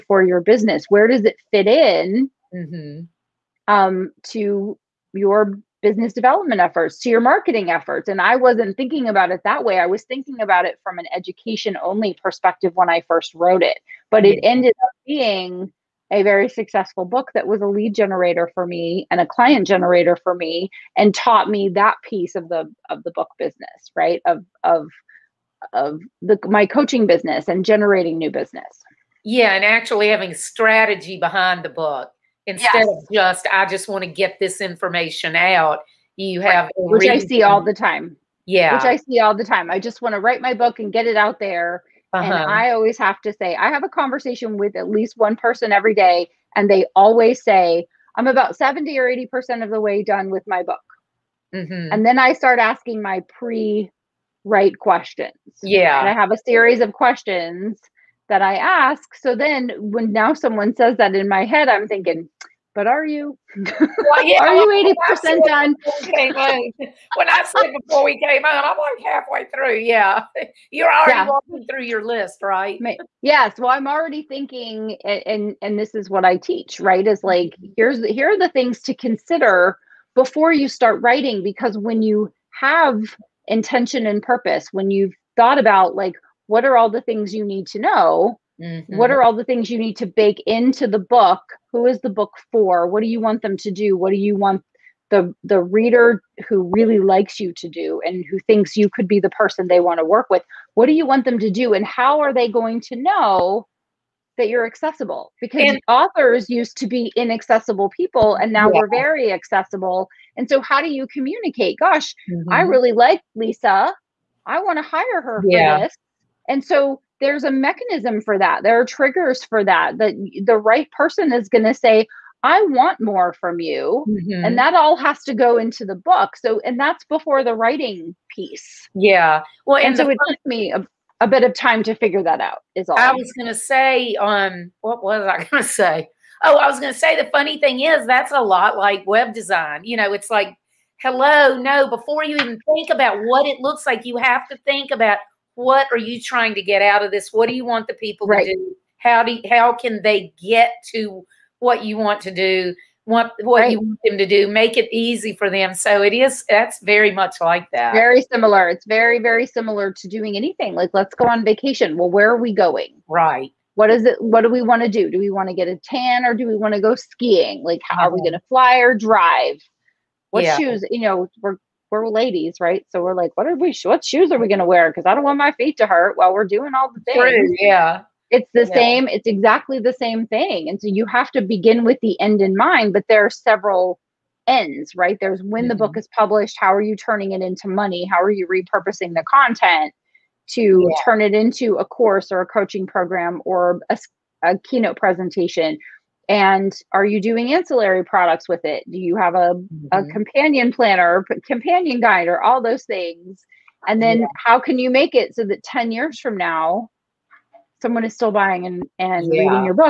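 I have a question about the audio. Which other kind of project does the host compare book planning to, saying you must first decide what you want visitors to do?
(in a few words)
Web design.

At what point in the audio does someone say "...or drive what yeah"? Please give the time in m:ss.
2:48.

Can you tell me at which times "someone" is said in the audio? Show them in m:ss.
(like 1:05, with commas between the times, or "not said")
1:00, 3:27.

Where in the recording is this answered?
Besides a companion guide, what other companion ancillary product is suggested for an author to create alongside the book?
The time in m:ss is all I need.
3:20.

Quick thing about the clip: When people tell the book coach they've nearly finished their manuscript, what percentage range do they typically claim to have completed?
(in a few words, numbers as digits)
70 or 80 percent.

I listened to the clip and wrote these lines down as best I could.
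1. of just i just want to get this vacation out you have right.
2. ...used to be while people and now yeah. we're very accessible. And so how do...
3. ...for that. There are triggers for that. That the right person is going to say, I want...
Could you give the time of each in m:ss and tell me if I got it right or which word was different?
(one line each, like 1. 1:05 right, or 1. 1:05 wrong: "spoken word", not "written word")
1. 0:32 wrong: "information", not "vacation"
2. 1:46 wrong: "inaccessible", not "while"
3. 1:58 right.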